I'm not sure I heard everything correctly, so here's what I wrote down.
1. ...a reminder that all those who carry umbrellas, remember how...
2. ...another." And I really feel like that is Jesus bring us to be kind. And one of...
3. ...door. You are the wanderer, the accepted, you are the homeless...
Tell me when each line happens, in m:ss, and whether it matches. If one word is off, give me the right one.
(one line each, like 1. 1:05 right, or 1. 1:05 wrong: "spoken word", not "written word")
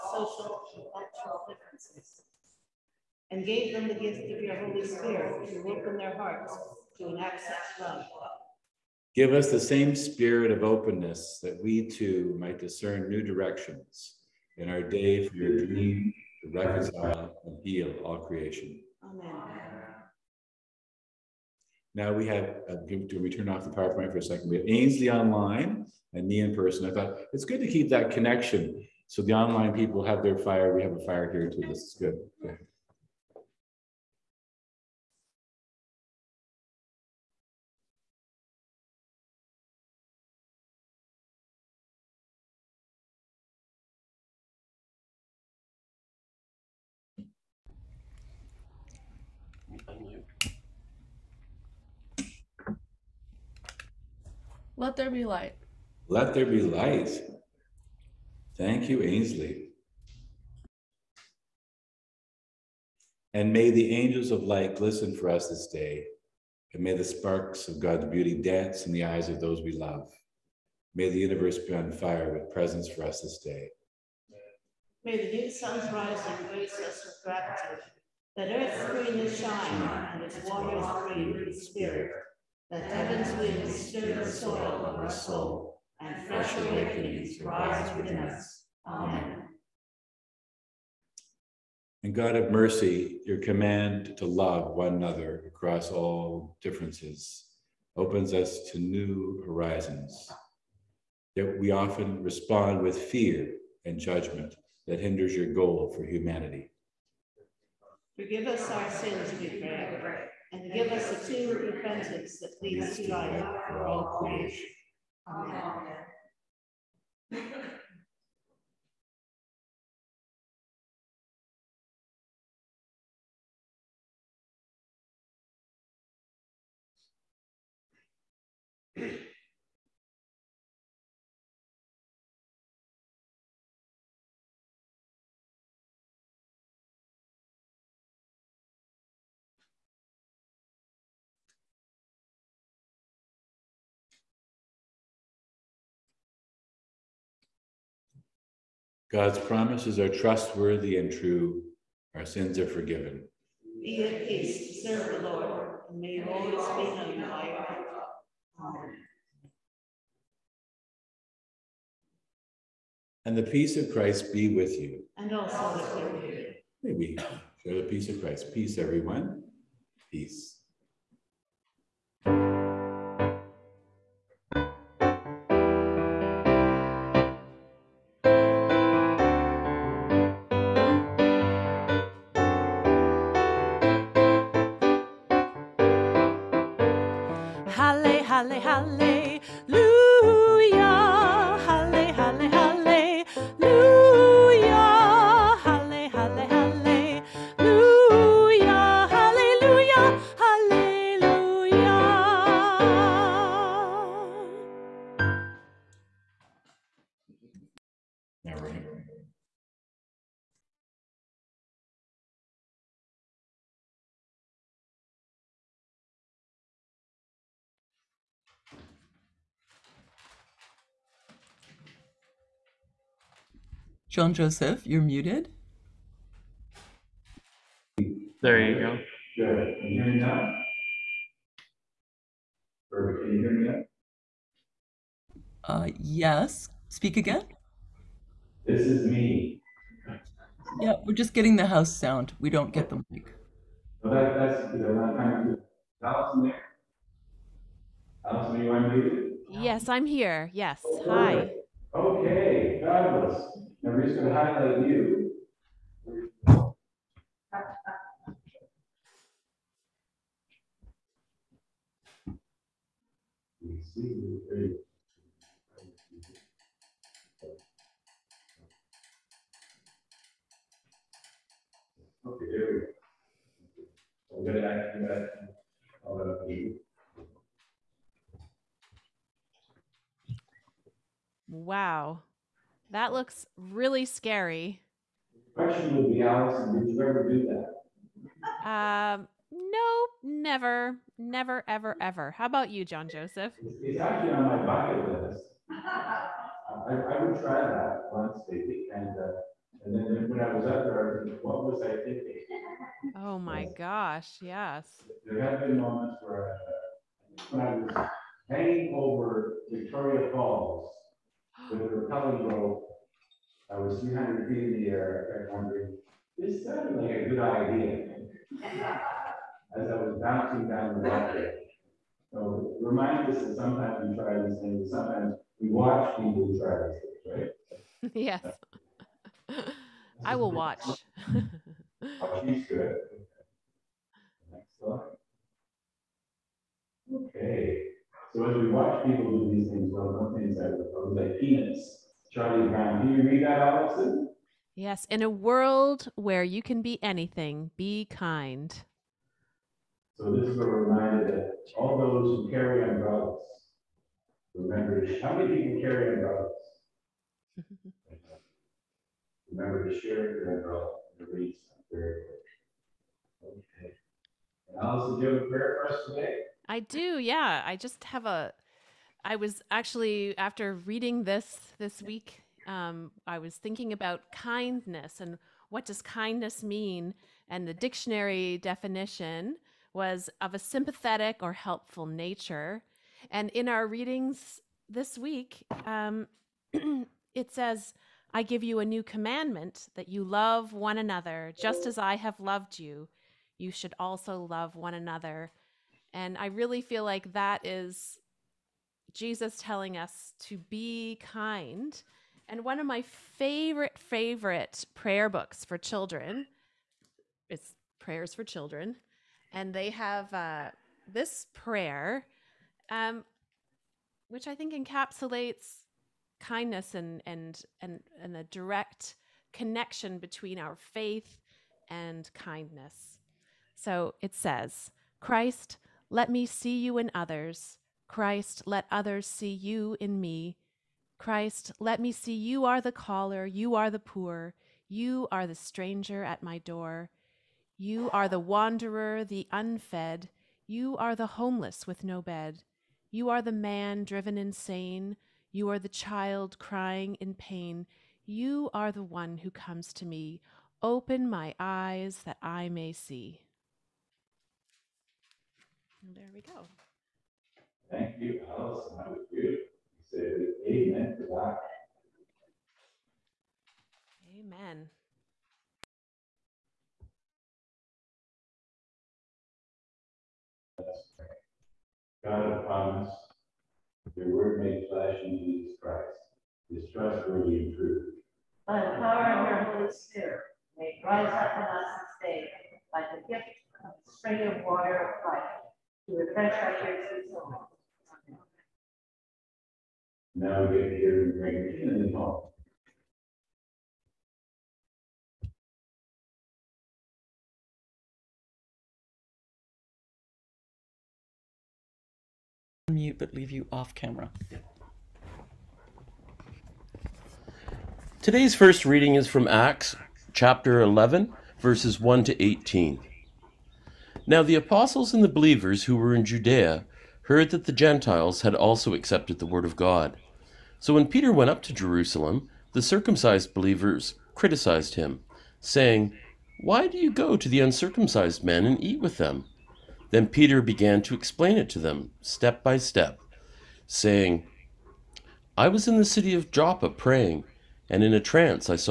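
1. 5:50 right
2. 6:34 wrong: "telling", not "bring"
3. 7:16 wrong: "unfed", not "accepted".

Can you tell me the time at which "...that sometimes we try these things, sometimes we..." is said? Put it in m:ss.
5:23.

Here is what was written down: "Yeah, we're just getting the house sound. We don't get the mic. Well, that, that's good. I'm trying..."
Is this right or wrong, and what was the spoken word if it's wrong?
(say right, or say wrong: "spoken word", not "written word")
right.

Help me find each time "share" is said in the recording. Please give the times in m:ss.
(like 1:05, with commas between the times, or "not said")
2:47, 5:59.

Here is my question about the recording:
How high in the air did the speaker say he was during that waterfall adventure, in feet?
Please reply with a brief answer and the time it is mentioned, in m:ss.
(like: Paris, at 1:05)
300, at 5:14.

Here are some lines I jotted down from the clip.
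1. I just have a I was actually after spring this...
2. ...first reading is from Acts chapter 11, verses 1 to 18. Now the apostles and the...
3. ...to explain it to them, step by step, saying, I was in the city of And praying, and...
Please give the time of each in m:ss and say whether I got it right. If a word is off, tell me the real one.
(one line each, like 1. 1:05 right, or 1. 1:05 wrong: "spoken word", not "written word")
1. 6:07 wrong: "reading", not "spring"
2. 8:28 right
3. 8:51 wrong: "Joppa", not "And".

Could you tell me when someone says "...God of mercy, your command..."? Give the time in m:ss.
1:32.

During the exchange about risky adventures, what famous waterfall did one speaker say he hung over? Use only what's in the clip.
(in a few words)
Victoria Falls.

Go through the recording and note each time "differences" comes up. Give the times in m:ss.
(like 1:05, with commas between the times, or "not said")
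0:01, 1:36.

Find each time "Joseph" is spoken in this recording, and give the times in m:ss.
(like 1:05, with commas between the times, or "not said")
3:44, 4:53.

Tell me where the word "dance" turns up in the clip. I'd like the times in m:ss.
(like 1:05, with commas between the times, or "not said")
1:08.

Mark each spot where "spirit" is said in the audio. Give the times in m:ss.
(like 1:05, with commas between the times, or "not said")
0:04, 0:09, 1:21, 7:59.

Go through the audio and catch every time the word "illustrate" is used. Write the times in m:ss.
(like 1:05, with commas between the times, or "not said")
not said.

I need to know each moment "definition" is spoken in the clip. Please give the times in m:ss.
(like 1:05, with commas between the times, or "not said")
6:18.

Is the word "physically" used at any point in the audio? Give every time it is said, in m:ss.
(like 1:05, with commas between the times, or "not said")
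not said.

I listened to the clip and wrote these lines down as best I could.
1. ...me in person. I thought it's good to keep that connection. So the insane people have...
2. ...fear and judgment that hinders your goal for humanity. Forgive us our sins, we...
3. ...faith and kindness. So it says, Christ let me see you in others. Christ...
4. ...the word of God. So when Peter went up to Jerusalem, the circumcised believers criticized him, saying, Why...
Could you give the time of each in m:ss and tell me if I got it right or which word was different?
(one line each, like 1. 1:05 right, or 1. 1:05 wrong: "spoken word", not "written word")
1. 0:26 wrong: "online", not "insane"
2. 1:42 right
3. 7:00 right
4. 8:39 right.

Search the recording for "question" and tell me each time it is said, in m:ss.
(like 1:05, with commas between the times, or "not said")
4:45.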